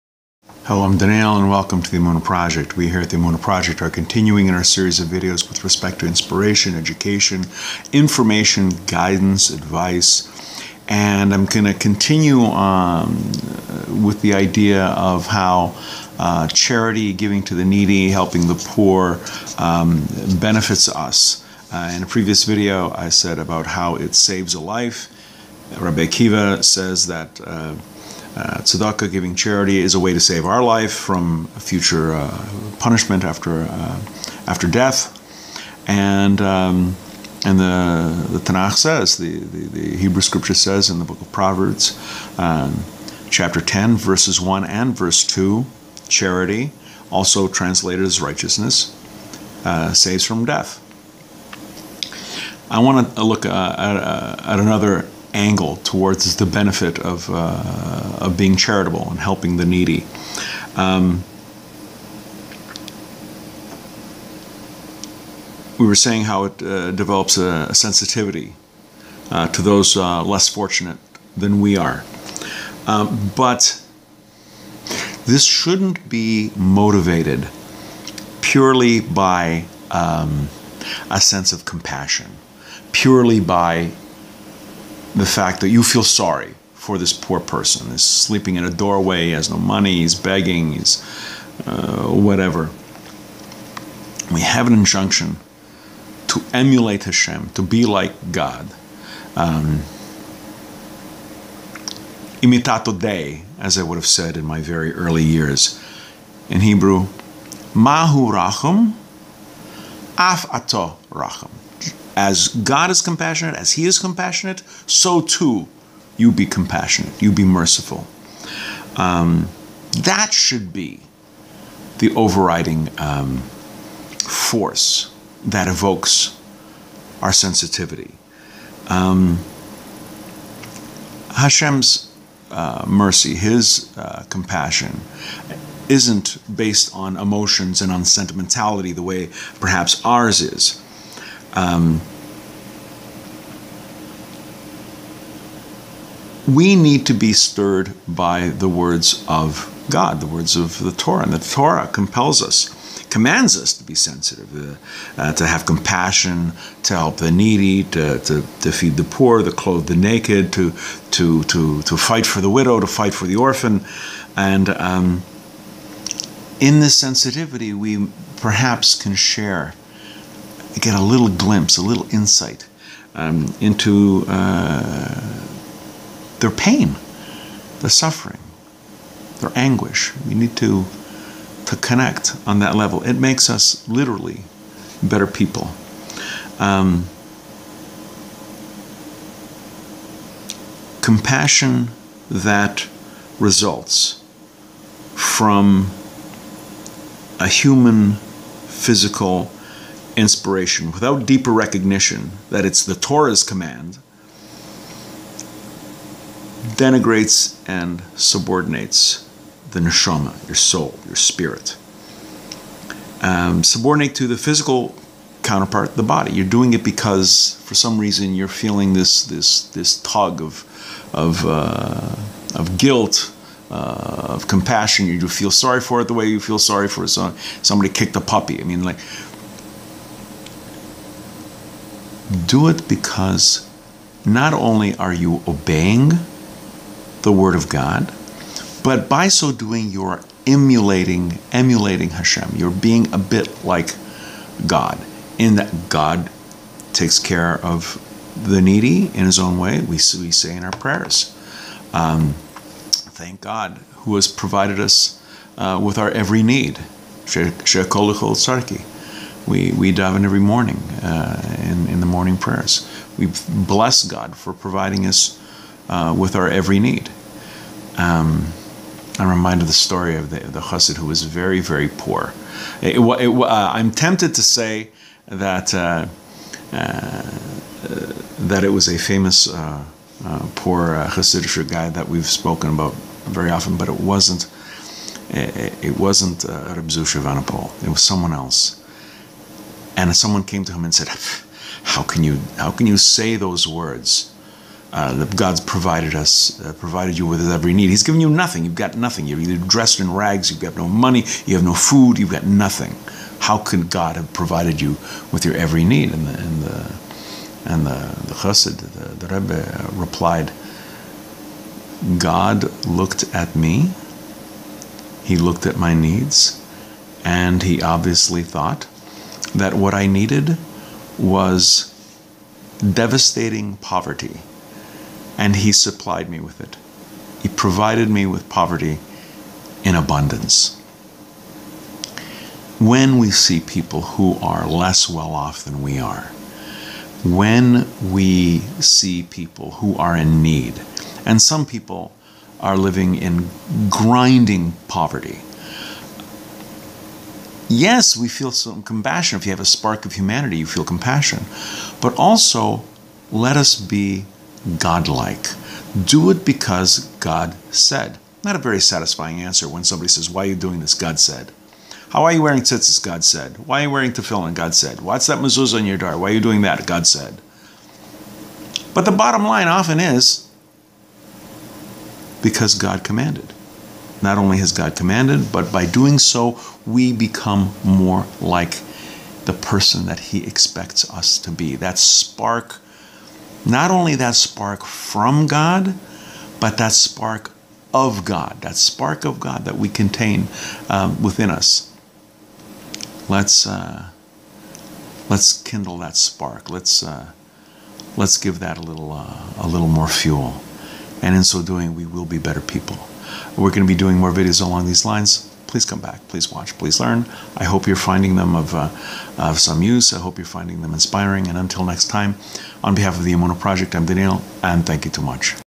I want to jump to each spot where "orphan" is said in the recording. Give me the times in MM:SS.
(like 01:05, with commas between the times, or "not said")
02:43.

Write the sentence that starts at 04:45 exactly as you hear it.
It, it wasn't uh, Reb Zusha Vanapol.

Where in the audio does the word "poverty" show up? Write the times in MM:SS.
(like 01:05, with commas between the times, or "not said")
05:23, 05:28, 05:44.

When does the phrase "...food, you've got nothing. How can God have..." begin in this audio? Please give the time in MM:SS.
05:01.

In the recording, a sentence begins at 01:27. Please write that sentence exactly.
He's sleeping in a doorway, he has no money, he's begging, he's uh, whatever.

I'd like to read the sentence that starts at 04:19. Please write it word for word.
We, we in every morning uh, in, in the morning prayers.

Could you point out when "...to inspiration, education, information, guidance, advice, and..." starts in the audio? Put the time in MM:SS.
00:05.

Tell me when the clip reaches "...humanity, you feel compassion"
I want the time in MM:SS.
05:50.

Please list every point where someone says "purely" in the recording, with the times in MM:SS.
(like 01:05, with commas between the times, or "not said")
01:18, 01:22.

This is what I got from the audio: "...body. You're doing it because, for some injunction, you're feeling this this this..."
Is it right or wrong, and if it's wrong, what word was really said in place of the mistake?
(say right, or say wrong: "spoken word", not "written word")
wrong: "reason", not "injunction".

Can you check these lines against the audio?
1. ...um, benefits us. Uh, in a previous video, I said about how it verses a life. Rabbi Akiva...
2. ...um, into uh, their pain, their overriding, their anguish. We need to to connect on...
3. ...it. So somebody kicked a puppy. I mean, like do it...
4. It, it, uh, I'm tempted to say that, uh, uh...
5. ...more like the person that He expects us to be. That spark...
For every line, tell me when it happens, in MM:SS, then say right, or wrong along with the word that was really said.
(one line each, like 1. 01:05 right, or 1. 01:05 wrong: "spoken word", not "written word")
1. 00:19 wrong: "saves", not "verses"
2. 02:53 wrong: "suffering", not "overriding"
3. 03:47 right
4. 04:32 right
5. 06:17 right.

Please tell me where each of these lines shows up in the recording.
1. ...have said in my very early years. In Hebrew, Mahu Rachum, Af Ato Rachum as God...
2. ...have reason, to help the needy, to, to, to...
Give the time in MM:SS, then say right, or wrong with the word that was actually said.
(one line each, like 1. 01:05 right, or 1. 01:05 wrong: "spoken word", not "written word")
1. 01:43 right
2. 02:35 wrong: "compassion", not "reason".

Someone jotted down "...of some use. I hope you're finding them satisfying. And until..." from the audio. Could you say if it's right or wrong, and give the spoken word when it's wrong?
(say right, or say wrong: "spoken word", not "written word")
wrong: "inspiring", not "satisfying".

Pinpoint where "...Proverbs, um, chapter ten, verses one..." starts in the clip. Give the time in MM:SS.
00:41.